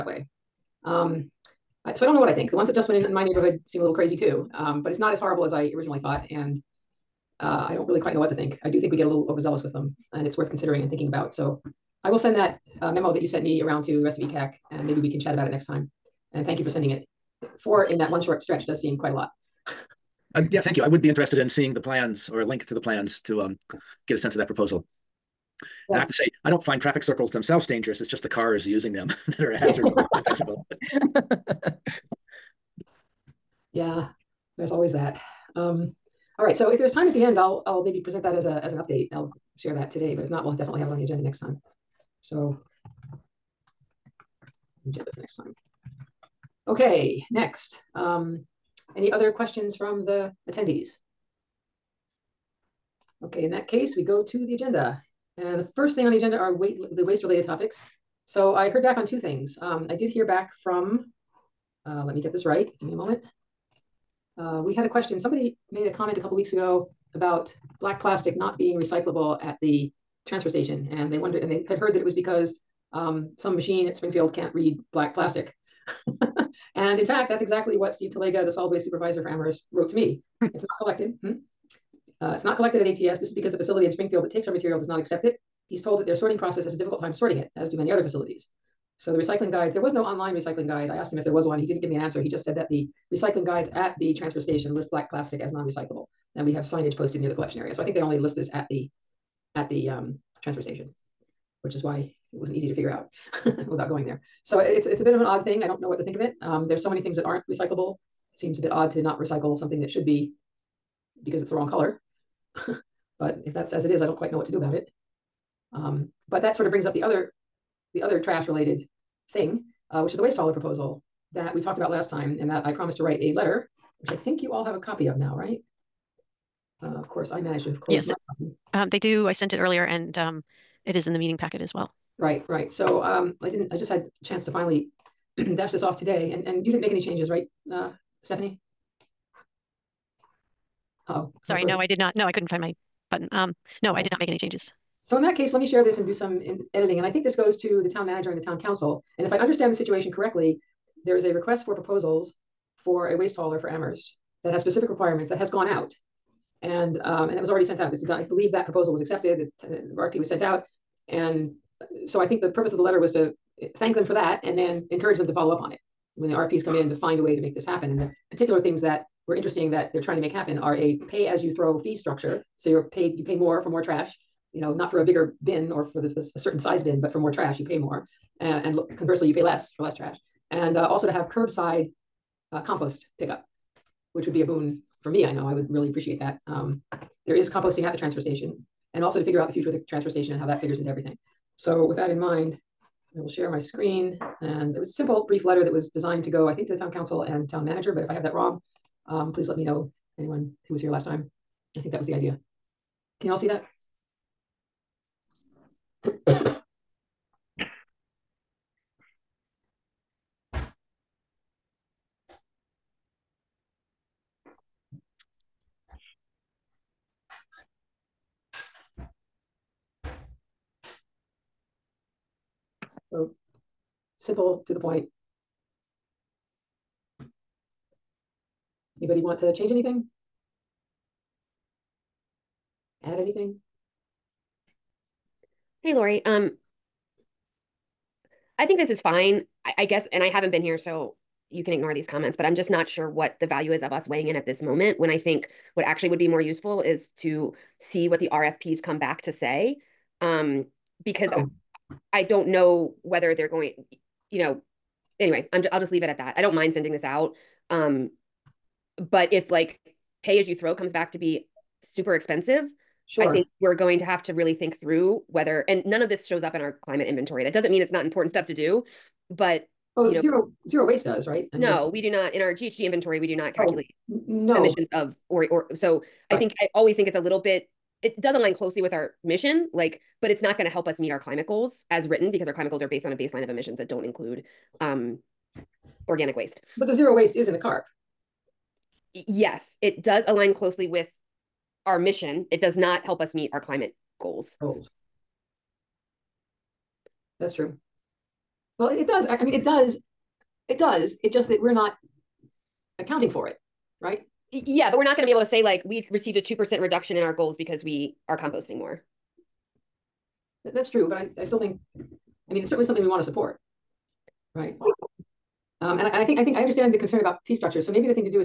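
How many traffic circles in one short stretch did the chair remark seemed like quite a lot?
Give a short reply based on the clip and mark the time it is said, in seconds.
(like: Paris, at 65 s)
4, at 17 s.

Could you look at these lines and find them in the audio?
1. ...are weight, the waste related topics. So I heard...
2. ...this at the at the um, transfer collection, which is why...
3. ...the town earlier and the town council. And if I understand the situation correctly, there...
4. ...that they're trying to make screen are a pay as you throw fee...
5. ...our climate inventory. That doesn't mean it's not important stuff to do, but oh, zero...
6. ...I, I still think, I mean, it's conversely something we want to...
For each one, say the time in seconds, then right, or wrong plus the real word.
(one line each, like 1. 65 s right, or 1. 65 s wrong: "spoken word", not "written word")
1. 56 s right
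2. 98 s wrong: "station", not "collection"
3. 147 s wrong: "manager", not "earlier"
4. 169 s wrong: "happen", not "screen"
5. 266 s right
6. 311 s wrong: "certainly", not "conversely".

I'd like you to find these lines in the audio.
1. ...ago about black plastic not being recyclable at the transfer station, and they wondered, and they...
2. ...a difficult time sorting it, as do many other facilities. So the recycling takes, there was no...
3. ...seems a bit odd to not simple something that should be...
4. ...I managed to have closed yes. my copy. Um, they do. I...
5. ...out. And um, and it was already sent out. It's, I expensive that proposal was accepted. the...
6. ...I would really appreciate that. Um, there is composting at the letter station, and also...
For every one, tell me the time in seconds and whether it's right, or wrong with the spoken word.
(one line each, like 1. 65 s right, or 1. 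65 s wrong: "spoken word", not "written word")
1. 66 s right
2. 86 s wrong: "guides", not "takes"
3. 108 s wrong: "recycle", not "simple"
4. 127 s right
5. 155 s wrong: "believe", not "expensive"
6. 185 s wrong: "transfer", not "letter".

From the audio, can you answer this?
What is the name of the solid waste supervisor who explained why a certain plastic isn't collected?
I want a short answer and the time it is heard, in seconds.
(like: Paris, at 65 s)
Steve Talega, at 77 s.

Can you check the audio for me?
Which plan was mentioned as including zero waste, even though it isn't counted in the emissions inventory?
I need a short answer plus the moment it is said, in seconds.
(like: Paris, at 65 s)
CARP, at 287 s.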